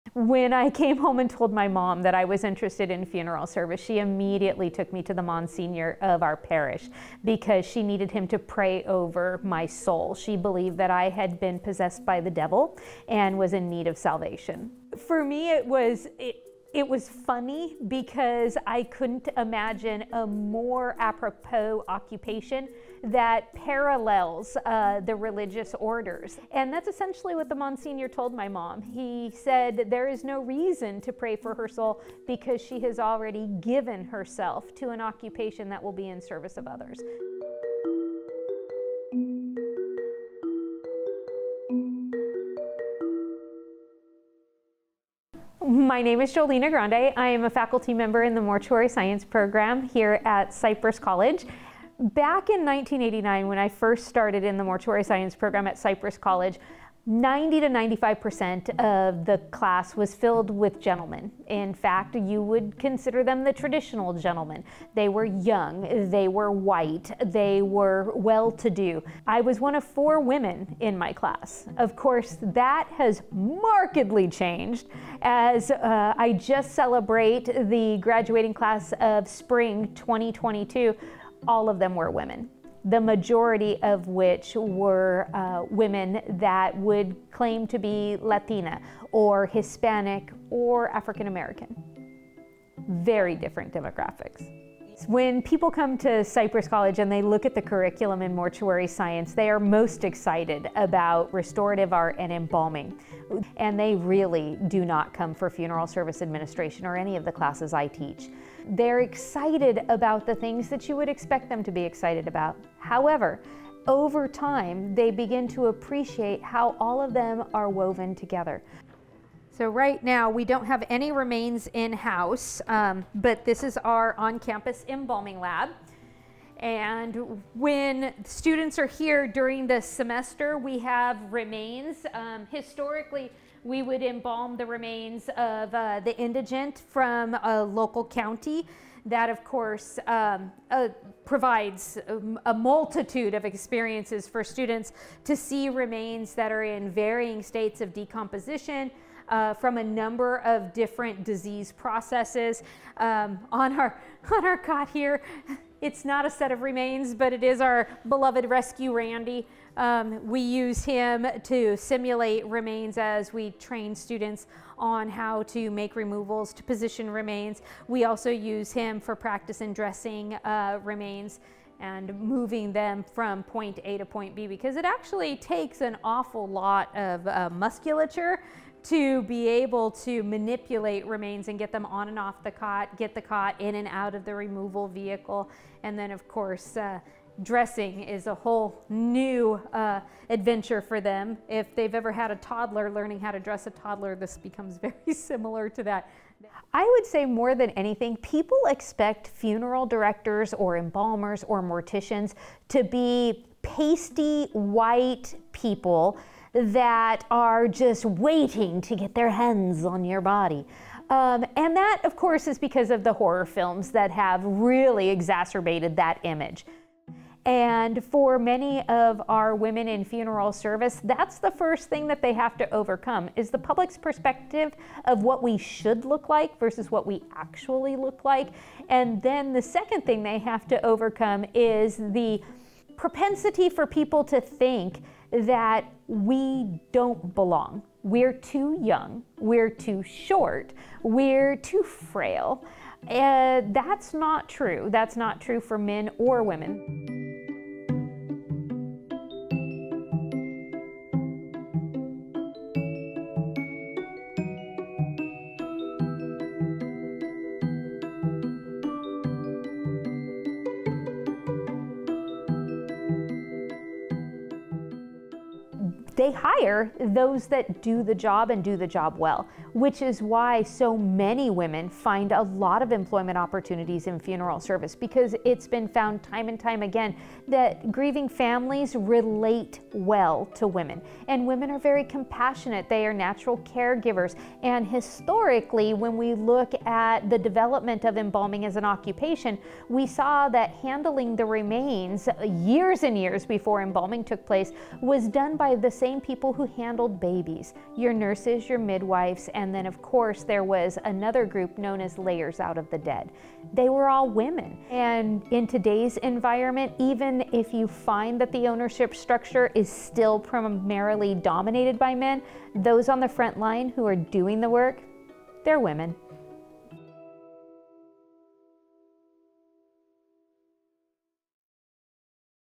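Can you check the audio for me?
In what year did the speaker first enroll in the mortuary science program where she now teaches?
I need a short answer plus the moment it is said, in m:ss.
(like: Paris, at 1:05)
1989, at 0:52.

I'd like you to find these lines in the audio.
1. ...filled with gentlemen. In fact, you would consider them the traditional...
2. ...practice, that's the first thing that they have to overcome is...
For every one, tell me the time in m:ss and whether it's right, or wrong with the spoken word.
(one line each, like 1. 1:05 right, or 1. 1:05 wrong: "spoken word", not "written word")
1. 1:00 right
2. 3:40 wrong: "service", not "practice".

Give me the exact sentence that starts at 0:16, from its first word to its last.
It, it was funny because I couldn't imagine a more apropos occupation that parallels uh, the religious orders.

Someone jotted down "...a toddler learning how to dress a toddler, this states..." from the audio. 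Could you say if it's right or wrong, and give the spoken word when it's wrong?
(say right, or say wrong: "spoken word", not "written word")
wrong: "becomes", not "states".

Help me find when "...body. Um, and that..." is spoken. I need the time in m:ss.
3:30.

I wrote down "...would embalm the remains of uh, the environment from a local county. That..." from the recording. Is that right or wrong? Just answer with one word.
wrong.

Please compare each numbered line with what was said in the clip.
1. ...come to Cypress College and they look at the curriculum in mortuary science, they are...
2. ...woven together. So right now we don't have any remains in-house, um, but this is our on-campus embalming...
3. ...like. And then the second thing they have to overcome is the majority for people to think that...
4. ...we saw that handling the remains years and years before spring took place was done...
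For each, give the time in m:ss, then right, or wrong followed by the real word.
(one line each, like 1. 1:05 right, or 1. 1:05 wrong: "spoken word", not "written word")
1. 1:35 right
2. 1:57 right
3. 3:48 wrong: "propensity", not "majority"
4. 4:49 wrong: "embalming", not "spring".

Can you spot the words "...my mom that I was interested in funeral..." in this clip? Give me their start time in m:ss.
0:01.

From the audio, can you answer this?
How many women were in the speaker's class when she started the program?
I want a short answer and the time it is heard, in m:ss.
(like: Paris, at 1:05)
4, at 1:09.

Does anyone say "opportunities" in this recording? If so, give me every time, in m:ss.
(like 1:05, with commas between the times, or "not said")
4:33.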